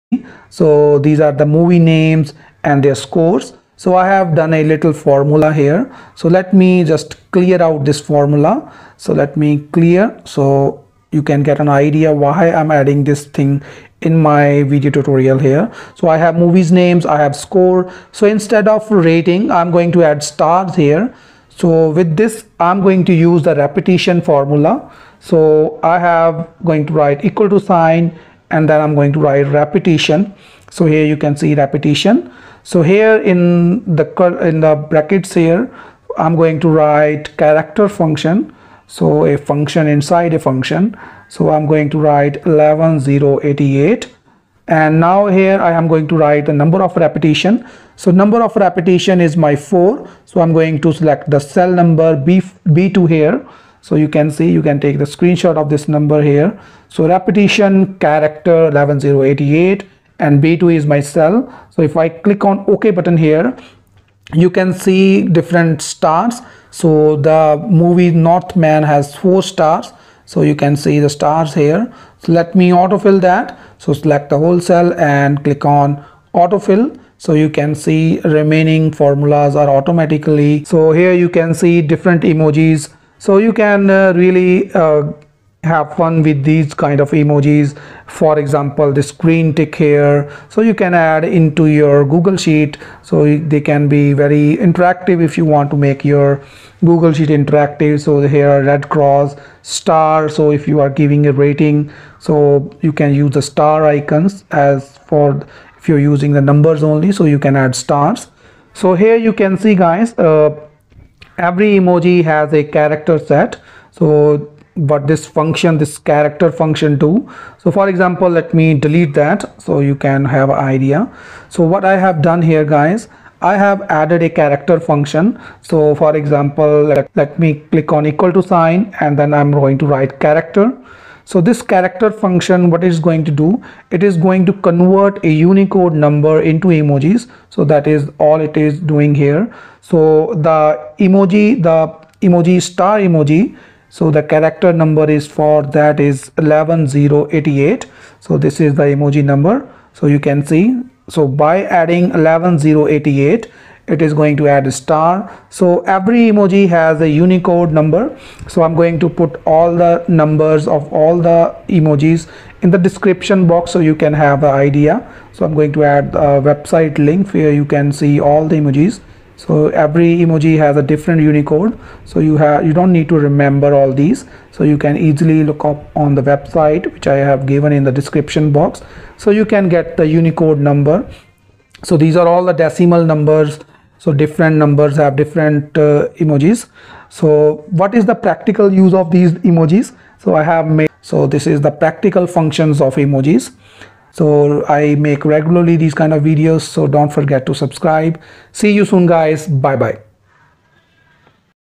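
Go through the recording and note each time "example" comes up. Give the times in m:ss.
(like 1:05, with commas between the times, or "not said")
1:28, 1:57, 2:06.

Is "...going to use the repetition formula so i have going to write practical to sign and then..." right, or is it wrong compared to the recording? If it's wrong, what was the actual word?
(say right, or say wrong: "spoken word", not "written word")
wrong: "equal", not "practical".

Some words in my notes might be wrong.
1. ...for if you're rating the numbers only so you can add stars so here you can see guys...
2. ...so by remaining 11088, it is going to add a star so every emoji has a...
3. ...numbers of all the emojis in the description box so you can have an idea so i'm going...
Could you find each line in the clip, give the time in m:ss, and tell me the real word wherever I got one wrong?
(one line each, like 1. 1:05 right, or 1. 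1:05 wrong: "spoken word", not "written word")
1. 1:45 wrong: "using", not "rating"
2. 2:31 wrong: "adding", not "remaining"
3. 2:40 right.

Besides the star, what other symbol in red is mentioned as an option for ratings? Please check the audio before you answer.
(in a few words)
red cross.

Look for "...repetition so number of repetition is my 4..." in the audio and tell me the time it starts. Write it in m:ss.
0:46.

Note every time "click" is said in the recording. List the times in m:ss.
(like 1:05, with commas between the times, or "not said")
1:02, 1:15, 2:07.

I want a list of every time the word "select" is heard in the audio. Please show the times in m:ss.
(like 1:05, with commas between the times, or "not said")
0:50, 1:13.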